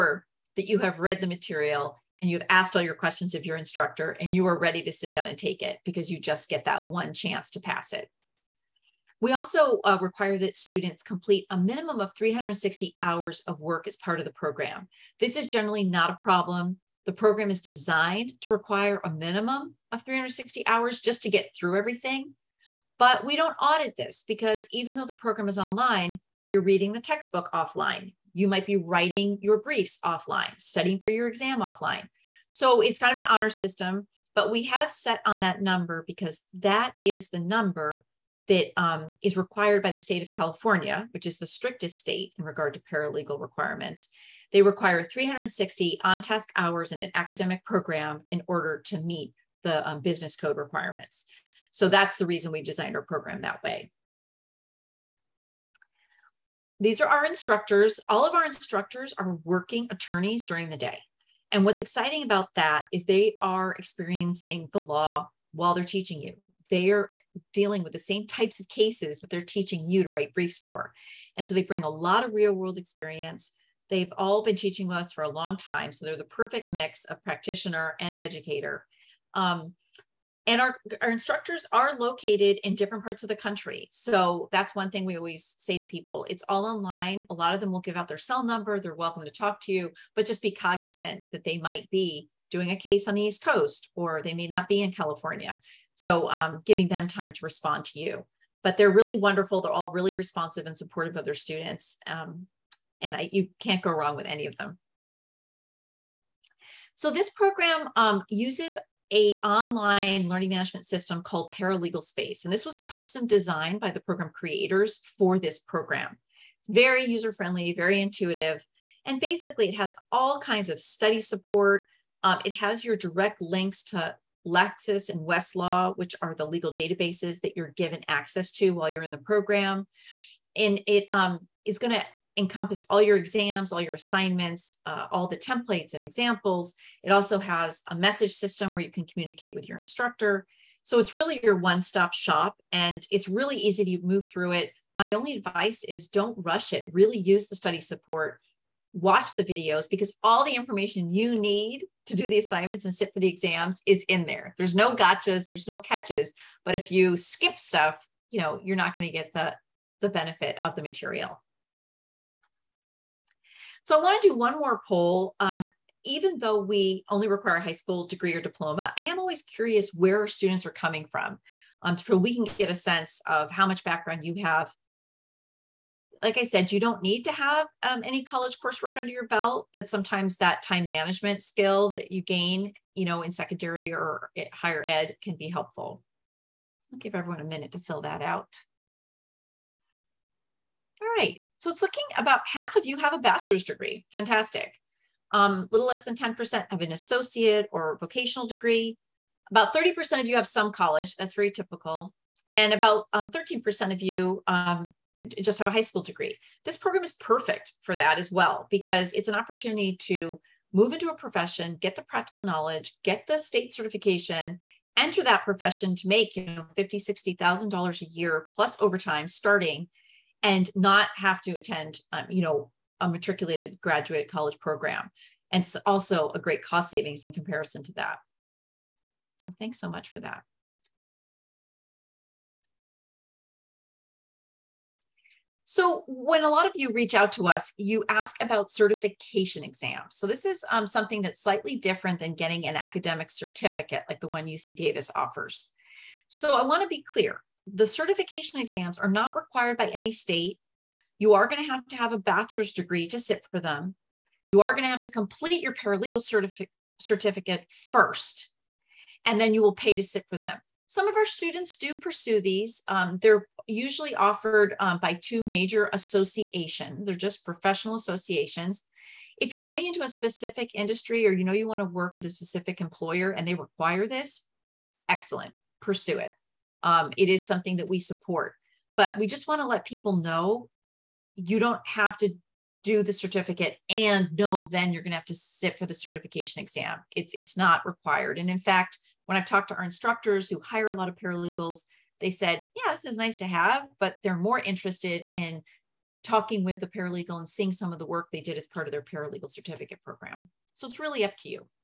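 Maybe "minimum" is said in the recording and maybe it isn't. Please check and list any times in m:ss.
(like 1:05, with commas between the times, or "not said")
0:11, 0:19.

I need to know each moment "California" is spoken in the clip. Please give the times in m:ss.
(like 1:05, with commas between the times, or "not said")
0:40, 1:34.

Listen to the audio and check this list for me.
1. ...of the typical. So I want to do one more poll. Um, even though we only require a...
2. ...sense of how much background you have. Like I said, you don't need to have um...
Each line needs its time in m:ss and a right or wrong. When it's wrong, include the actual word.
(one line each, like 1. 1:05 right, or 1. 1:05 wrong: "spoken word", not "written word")
1. 2:40 wrong: "material", not "typical"
2. 2:52 right.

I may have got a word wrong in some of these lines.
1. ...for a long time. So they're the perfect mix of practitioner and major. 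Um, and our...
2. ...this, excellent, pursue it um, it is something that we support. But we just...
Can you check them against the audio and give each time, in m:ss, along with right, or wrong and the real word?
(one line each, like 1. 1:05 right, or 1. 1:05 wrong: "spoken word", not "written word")
1. 1:15 wrong: "educator", not "major"
2. 4:34 right.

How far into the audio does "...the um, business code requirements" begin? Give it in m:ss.
0:49.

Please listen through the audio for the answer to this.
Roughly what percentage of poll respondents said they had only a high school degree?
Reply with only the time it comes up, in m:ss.
3:23.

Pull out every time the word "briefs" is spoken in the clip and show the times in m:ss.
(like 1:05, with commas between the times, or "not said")
0:29, 1:10.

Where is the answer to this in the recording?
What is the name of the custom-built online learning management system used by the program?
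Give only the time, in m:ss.
1:51.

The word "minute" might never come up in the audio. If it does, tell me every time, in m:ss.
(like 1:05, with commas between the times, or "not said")
3:07.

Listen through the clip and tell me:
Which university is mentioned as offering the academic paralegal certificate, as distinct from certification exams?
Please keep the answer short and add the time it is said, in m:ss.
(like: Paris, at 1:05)
UC Davis, at 4:04.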